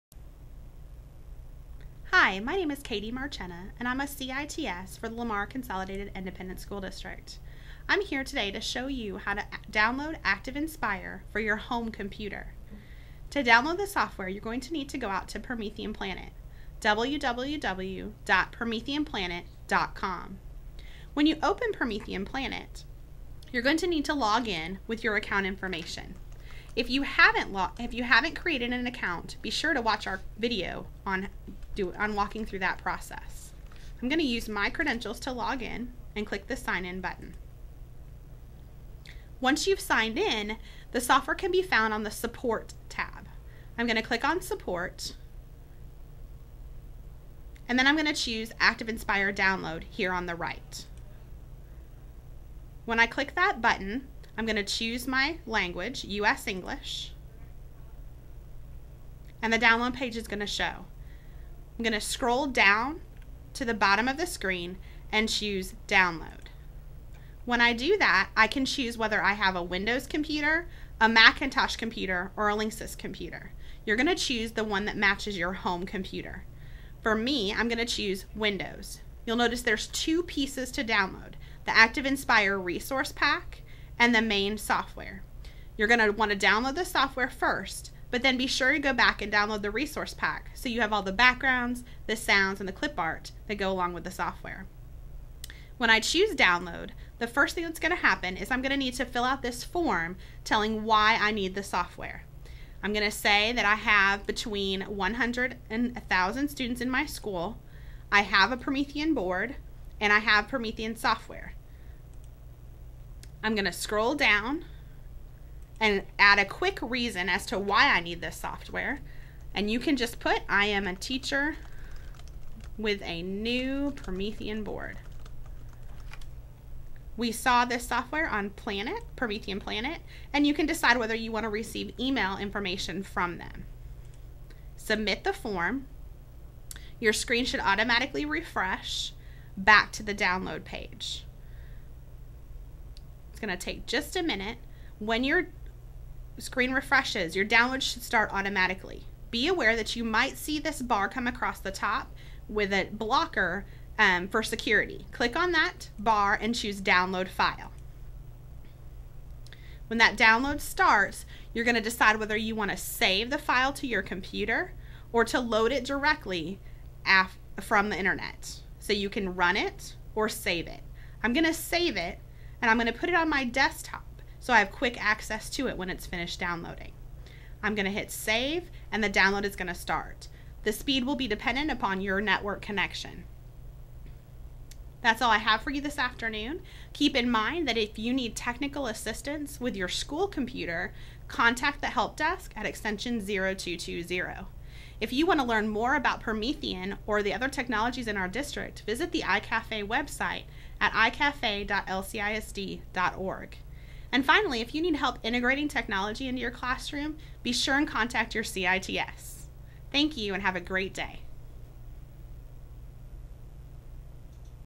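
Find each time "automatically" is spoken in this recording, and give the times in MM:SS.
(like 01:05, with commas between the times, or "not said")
02:17, 02:28.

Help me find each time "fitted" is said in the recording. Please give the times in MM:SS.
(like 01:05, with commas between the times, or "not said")
not said.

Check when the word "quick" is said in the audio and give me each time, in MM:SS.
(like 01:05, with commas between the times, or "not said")
01:56, 02:54.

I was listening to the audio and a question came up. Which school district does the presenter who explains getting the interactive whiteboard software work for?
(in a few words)
Lamar Consolidated Independent School District.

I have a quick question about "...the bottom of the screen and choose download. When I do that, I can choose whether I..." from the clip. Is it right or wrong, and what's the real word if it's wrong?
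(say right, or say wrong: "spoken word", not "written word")
right.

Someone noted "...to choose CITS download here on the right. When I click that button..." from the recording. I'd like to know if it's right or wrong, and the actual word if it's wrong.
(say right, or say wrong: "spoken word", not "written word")
wrong: "ActivInspire", not "CITS".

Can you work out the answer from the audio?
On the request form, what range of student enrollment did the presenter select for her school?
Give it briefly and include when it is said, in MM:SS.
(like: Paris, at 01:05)
100 to 1,000, at 01:44.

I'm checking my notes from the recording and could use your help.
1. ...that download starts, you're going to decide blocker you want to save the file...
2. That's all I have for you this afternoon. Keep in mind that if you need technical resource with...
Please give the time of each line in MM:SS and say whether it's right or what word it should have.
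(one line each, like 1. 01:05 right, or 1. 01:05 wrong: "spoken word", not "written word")
1. 02:39 wrong: "whether", not "blocker"
2. 03:05 wrong: "assistance", not "resource".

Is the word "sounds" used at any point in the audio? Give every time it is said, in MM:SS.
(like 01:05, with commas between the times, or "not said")
01:32.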